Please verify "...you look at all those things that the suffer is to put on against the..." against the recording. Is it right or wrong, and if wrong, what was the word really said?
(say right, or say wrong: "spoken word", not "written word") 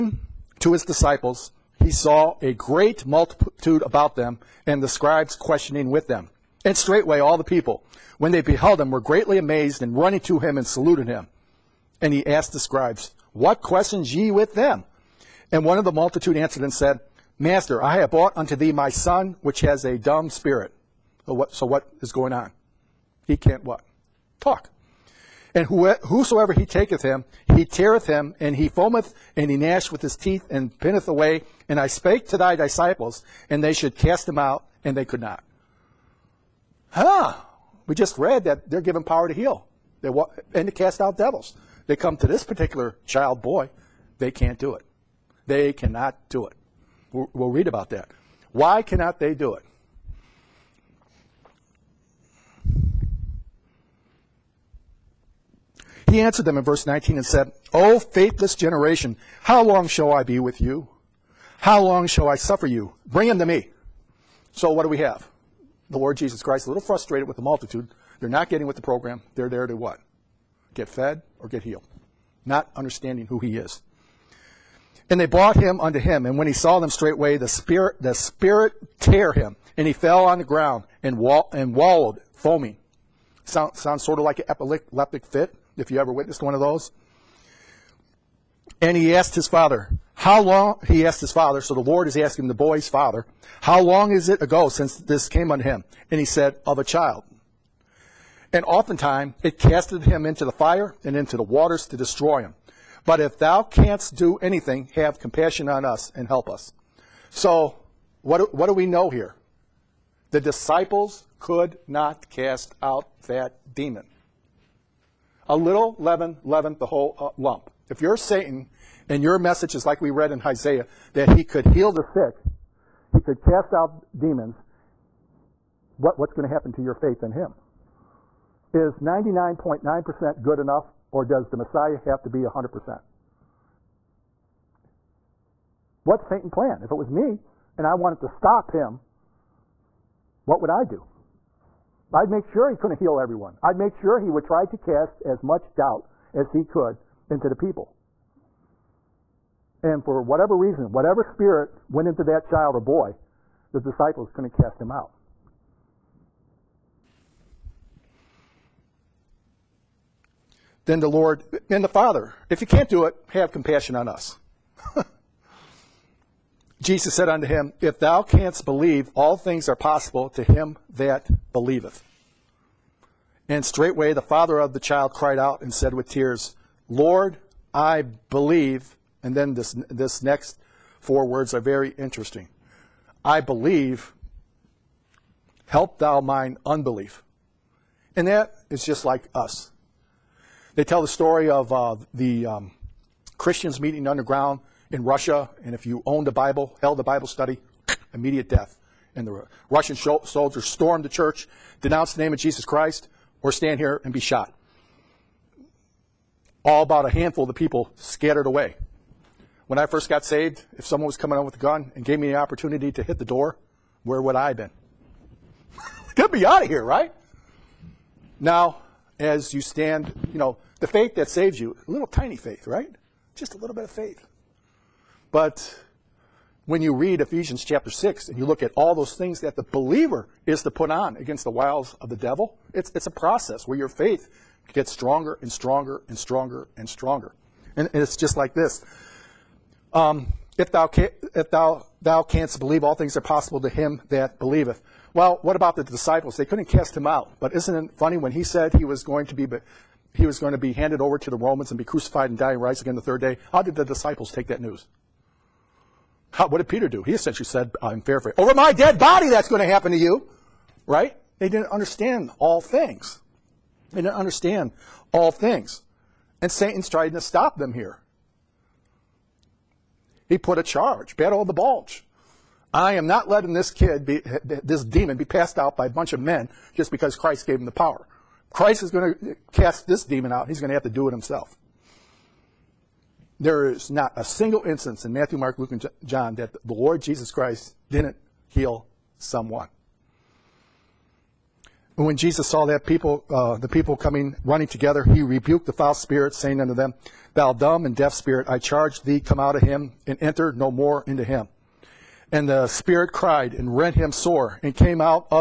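wrong: "believer", not "suffer".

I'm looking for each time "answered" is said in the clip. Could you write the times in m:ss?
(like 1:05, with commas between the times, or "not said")
0:16, 0:56.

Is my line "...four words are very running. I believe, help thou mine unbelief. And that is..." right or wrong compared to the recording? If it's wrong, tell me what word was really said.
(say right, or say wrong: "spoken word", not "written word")
wrong: "interesting", not "running".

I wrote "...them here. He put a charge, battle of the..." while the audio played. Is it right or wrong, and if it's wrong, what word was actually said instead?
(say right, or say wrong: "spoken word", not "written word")
right.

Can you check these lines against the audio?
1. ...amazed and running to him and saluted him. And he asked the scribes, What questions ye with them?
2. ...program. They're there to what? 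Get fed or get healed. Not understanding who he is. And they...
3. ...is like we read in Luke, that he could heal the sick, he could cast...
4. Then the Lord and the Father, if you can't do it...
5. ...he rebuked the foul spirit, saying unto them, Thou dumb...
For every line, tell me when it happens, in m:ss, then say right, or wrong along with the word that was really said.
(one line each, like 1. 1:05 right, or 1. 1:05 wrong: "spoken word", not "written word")
1. 0:09 right
2. 1:08 right
3. 1:59 wrong: "Isaiah", not "Luke"
4. 2:40 right
5. 4:55 right.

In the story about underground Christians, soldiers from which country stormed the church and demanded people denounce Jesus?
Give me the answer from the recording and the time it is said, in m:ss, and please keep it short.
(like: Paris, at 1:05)
Russian, at 3:19.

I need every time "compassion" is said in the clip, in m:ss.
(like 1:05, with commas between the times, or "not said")
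1:45, 2:43.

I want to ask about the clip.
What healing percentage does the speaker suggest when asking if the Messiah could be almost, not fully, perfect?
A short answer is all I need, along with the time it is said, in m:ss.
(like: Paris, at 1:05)
99.9%, at 2:08.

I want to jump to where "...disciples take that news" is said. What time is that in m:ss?
4:13.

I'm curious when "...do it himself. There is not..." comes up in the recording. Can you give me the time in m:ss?
4:40.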